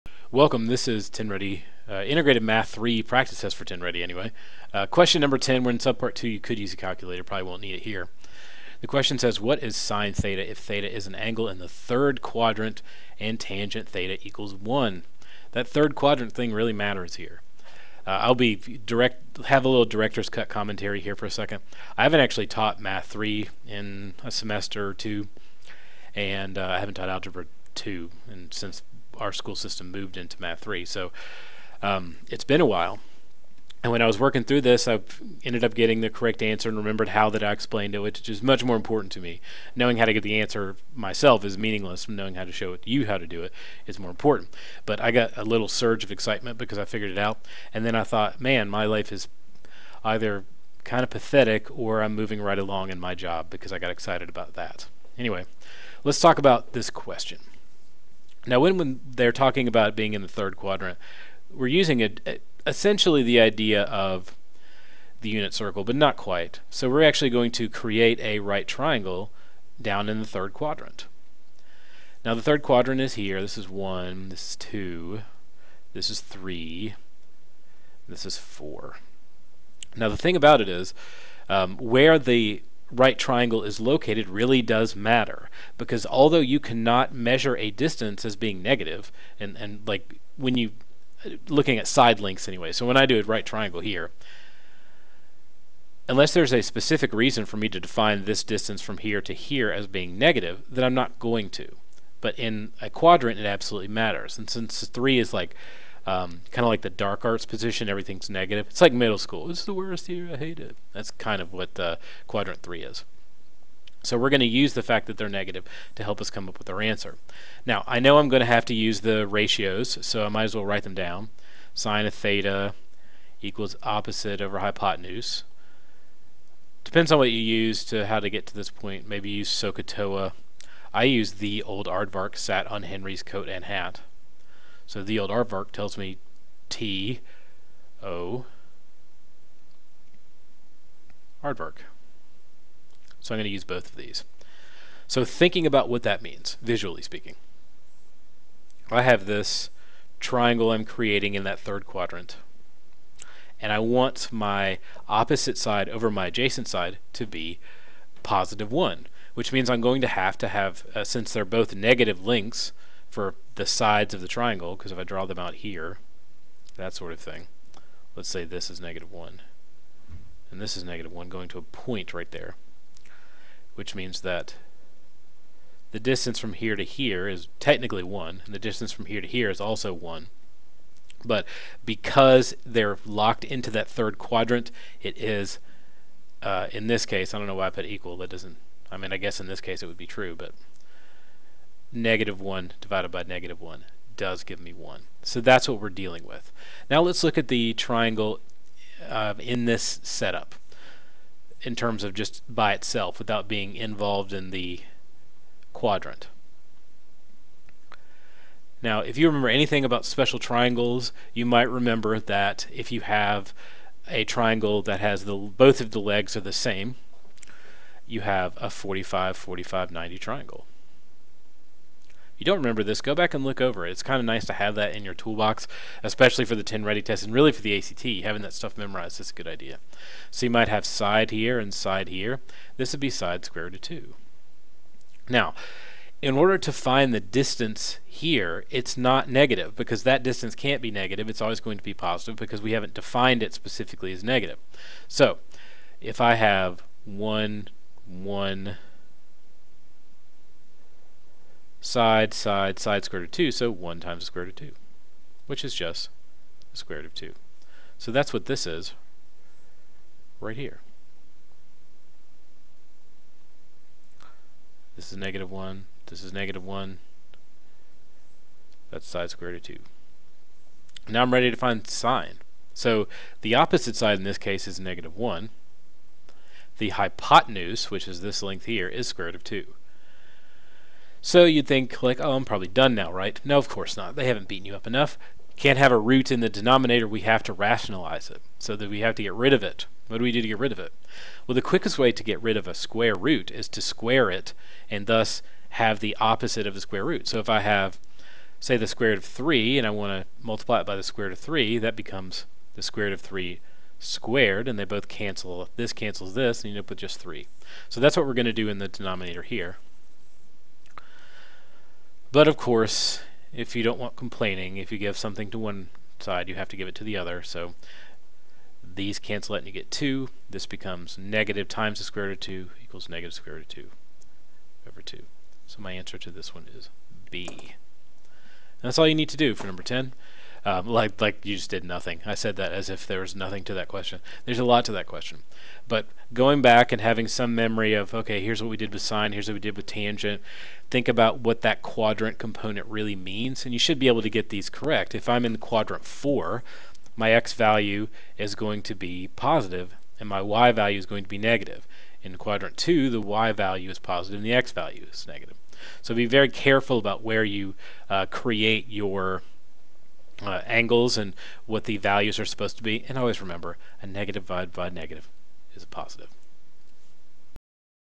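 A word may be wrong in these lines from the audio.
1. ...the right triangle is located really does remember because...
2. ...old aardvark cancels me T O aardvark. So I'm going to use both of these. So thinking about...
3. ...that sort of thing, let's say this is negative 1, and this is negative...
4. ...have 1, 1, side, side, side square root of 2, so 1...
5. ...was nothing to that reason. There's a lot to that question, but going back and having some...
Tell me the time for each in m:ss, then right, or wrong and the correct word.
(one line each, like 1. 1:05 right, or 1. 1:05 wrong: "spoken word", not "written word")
1. 1:22 wrong: "matter", not "remember"
2. 2:15 wrong: "tells", not "cancels"
3. 2:46 right
4. 4:06 right
5. 5:33 wrong: "question", not "reason".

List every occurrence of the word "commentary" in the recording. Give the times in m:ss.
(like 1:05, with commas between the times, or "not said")
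0:20.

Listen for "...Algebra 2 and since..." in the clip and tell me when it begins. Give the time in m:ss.
0:27.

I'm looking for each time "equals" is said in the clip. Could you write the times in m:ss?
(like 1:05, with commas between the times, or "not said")
0:14, 2:03, 3:07, 5:22.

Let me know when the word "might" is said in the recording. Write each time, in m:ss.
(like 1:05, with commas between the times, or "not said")
2:00, 3:31, 3:50.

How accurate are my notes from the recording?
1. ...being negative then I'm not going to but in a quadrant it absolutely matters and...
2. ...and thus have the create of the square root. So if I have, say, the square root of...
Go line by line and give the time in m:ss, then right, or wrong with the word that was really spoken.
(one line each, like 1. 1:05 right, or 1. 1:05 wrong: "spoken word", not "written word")
1. 1:39 right
2. 4:54 wrong: "opposite", not "create".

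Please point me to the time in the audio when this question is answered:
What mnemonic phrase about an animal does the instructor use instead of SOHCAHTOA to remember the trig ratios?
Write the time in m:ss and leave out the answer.
2:11.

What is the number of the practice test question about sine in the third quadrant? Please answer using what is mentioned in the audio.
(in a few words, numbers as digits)
10.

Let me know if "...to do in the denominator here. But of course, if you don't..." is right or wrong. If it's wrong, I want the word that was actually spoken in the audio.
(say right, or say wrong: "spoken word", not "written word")
right.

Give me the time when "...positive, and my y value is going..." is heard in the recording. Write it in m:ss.
5:49.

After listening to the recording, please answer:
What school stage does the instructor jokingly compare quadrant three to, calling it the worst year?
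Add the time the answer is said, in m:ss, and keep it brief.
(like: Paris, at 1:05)
middle school, at 1:48.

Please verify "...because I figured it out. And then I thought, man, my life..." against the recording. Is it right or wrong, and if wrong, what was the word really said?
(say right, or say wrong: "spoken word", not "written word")
right.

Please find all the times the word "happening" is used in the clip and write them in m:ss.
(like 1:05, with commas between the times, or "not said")
not said.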